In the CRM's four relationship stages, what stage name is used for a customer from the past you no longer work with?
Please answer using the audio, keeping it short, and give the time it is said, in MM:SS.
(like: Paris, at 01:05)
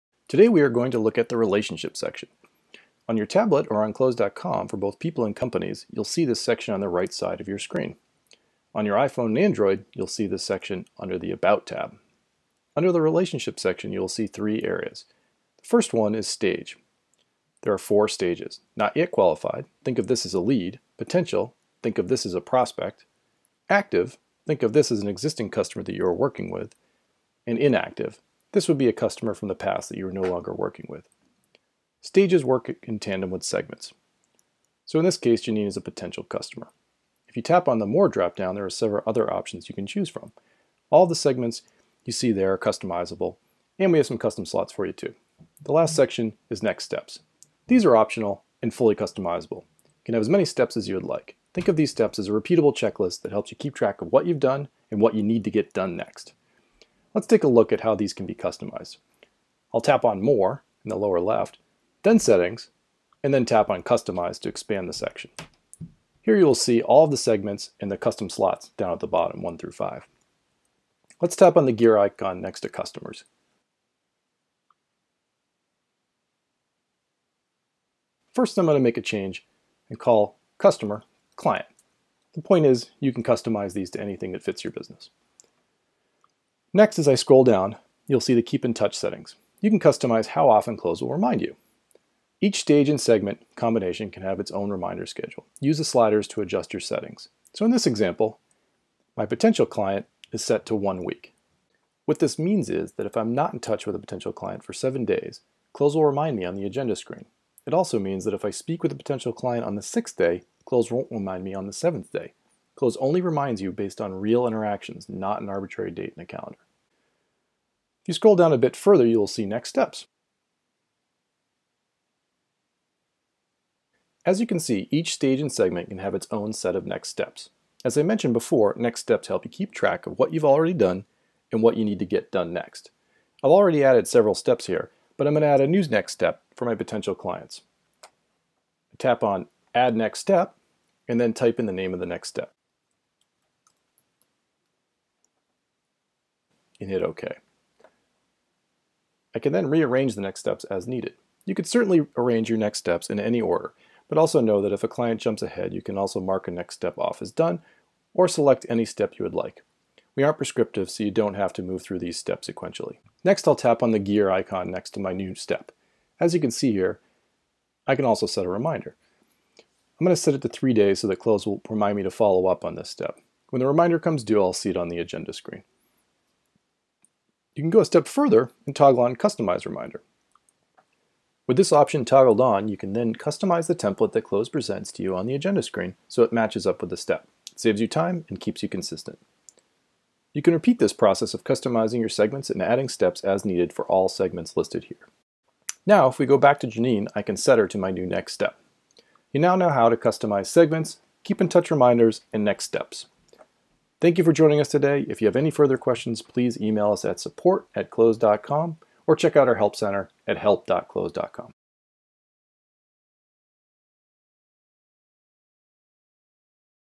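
Inactive, at 00:27.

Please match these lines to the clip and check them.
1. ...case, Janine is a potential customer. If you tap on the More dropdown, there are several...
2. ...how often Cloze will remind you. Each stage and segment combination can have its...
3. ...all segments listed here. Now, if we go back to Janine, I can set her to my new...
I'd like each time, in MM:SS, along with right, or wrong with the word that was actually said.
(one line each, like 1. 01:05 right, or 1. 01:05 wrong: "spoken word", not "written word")
1. 00:35 right
2. 01:30 right
3. 03:13 right.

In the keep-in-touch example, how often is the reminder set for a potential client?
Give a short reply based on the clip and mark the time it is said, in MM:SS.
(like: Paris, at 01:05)
1 week, at 01:40.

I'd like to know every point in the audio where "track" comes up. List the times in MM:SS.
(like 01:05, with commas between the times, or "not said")
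00:53, 02:09.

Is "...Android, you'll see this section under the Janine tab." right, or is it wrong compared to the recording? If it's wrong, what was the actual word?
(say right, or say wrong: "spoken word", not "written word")
wrong: "About", not "Janine".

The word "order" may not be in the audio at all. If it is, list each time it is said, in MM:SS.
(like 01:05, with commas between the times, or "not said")
02:33.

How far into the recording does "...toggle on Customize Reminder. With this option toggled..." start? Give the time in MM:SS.
02:58.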